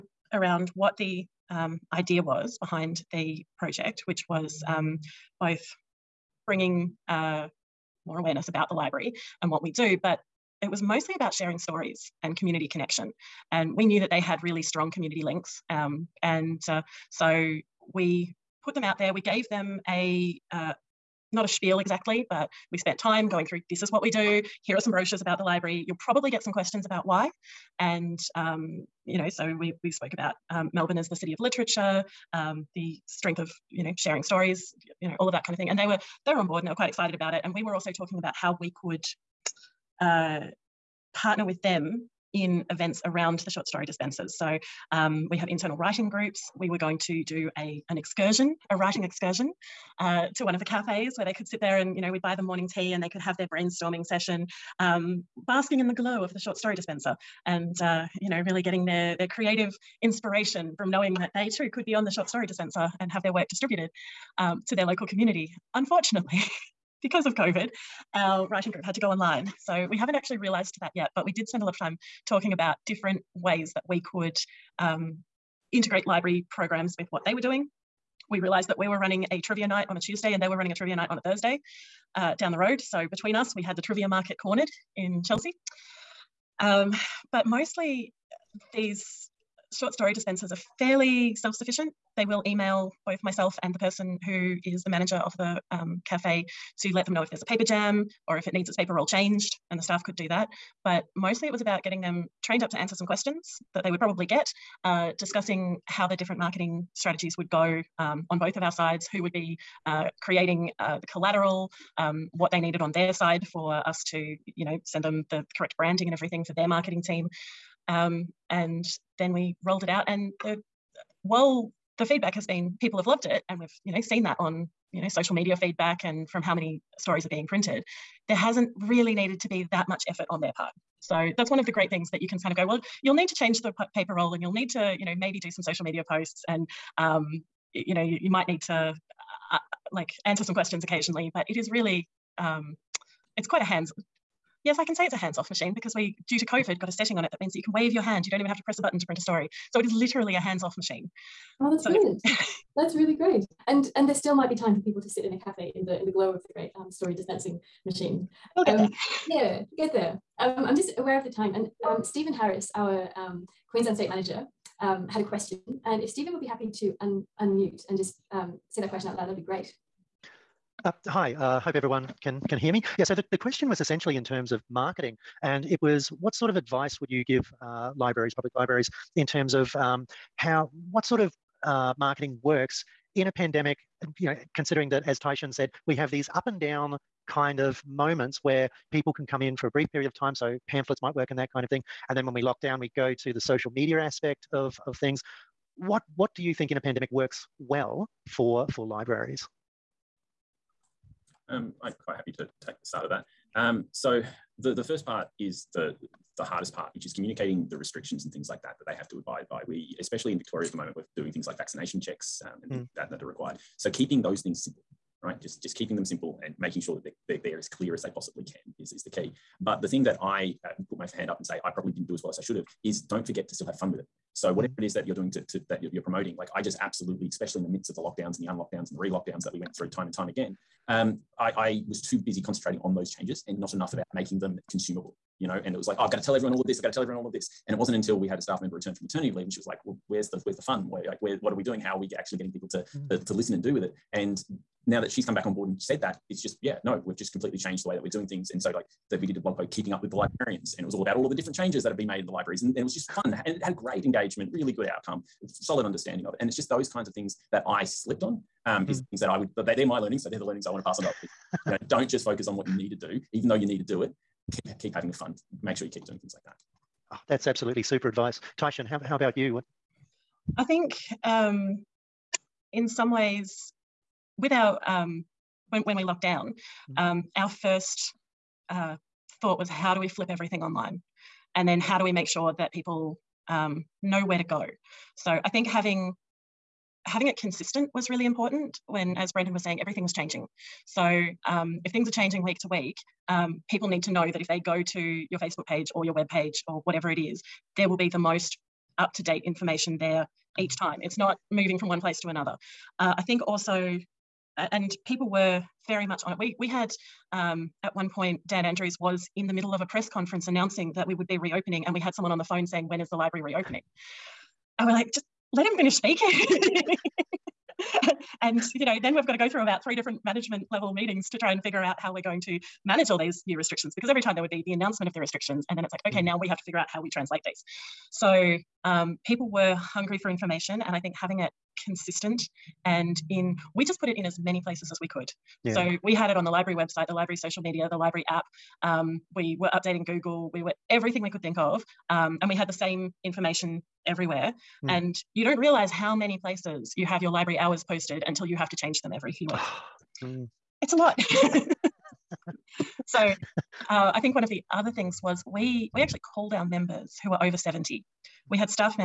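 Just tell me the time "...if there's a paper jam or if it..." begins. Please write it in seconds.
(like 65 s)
97 s.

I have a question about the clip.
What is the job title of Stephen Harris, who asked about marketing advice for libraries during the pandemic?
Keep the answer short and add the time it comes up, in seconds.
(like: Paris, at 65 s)
Queensland State Manager, at 163 s.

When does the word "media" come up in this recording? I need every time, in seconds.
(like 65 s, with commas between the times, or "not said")
125 s, 135 s, 193 s, 337 s.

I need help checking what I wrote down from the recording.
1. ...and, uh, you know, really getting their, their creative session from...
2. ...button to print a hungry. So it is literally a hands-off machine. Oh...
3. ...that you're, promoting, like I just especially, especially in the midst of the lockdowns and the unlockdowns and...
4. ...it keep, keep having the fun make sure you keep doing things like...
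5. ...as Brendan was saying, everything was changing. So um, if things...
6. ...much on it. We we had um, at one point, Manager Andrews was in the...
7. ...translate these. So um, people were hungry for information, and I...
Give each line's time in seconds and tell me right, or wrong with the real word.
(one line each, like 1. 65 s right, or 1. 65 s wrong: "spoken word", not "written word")
1. 57 s wrong: "inspiration", not "session"
2. 148 s wrong: "story", not "hungry"
3. 225 s wrong: "absolutely", not "especially"
4. 264 s right
5. 289 s right
6. 306 s wrong: "Dan", not "Manager"
7. 327 s right.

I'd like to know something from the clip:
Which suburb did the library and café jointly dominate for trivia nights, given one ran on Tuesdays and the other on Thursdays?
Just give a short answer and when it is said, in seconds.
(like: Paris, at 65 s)
Chelsea, at 85 s.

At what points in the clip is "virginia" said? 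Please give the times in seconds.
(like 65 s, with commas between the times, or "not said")
not said.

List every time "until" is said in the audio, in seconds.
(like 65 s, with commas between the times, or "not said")
237 s, 348 s.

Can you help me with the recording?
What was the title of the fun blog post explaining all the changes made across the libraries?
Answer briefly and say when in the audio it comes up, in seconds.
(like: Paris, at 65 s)
Keeping up with the librarians, at 249 s.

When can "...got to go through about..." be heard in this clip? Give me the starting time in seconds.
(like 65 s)
319 s.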